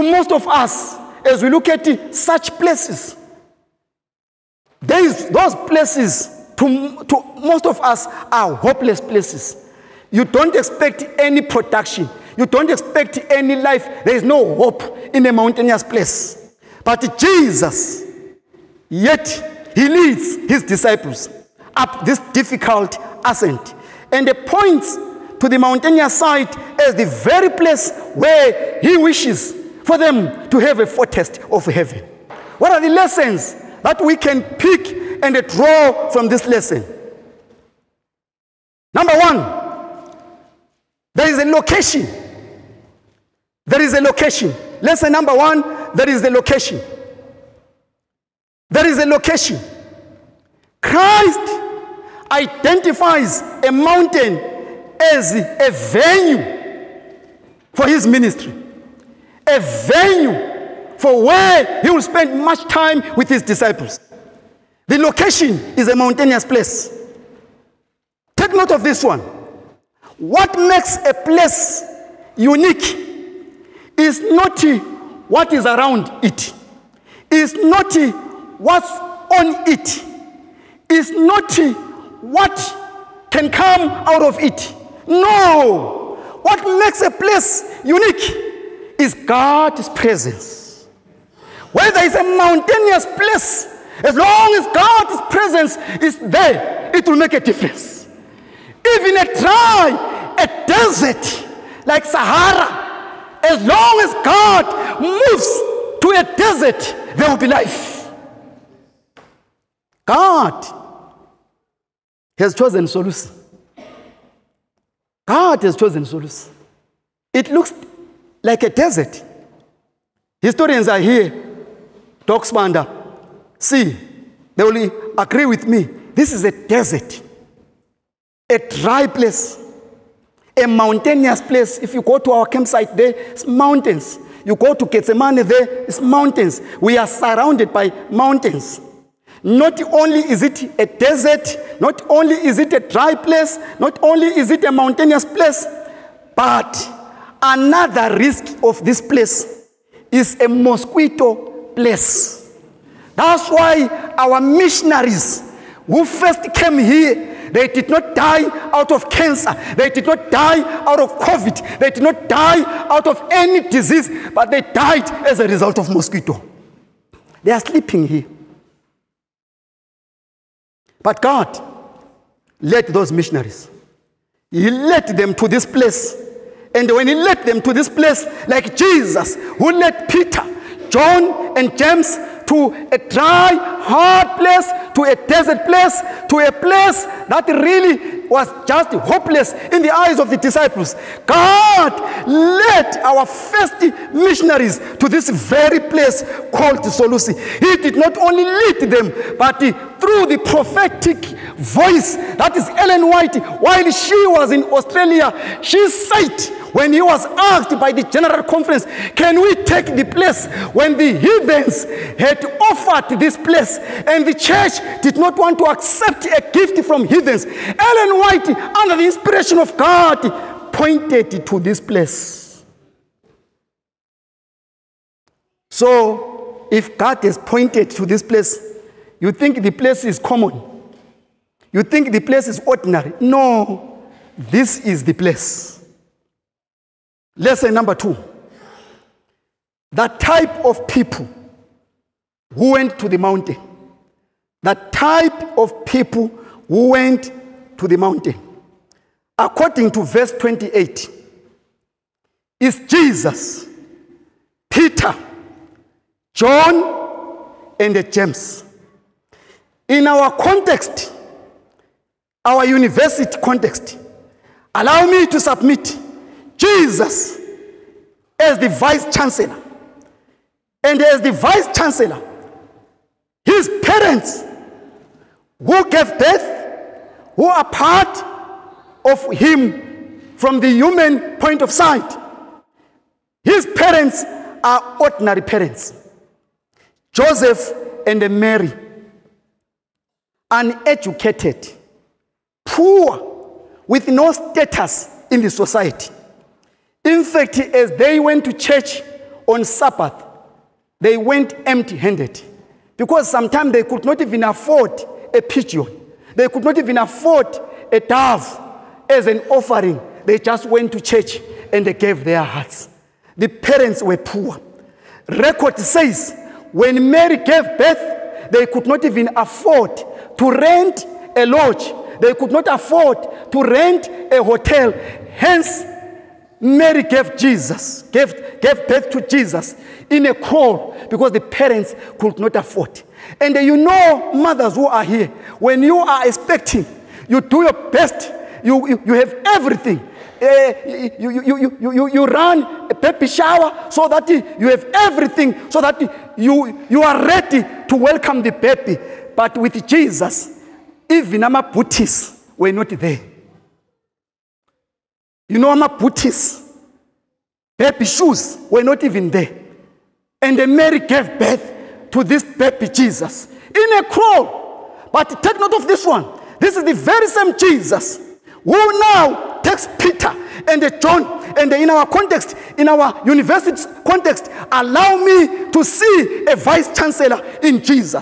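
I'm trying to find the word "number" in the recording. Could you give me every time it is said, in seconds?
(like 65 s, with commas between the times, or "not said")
38 s, 45 s, 237 s.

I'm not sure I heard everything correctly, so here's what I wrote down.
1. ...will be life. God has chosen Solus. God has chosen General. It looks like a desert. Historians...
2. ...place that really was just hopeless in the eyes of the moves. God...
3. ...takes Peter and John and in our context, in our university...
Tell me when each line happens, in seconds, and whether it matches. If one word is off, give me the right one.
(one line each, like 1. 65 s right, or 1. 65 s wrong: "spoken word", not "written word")
1. 107 s wrong: "Solus", not "General"
2. 186 s wrong: "disciples", not "moves"
3. 369 s right.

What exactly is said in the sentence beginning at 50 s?
Christ identifies a mountain as a venue for his ministry, a venue for where he will spend much time with his disciples.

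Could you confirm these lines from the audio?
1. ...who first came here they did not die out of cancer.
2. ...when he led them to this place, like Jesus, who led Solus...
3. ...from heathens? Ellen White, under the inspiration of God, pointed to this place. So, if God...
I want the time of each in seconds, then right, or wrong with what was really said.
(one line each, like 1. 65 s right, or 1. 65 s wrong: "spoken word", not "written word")
1. 155 s right
2. 176 s wrong: "Peter", not "Solus"
3. 216 s right.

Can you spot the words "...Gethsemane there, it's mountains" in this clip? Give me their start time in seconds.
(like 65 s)
134 s.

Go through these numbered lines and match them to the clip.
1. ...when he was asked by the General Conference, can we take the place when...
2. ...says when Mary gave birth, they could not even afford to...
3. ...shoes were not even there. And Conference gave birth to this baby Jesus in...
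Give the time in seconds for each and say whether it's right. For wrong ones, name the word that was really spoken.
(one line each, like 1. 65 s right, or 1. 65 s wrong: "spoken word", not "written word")
1. 206 s right
2. 315 s right
3. 358 s wrong: "Mary", not "Conference".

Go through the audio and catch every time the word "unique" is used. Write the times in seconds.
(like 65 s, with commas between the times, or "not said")
72 s, 87 s.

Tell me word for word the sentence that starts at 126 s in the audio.
This is a desert, a dry place, a mountainous place.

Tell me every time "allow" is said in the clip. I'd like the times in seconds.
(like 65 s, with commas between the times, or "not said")
264 s, 374 s.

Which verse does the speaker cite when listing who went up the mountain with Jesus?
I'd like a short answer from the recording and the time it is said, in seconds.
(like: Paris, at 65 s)
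28, at 250 s.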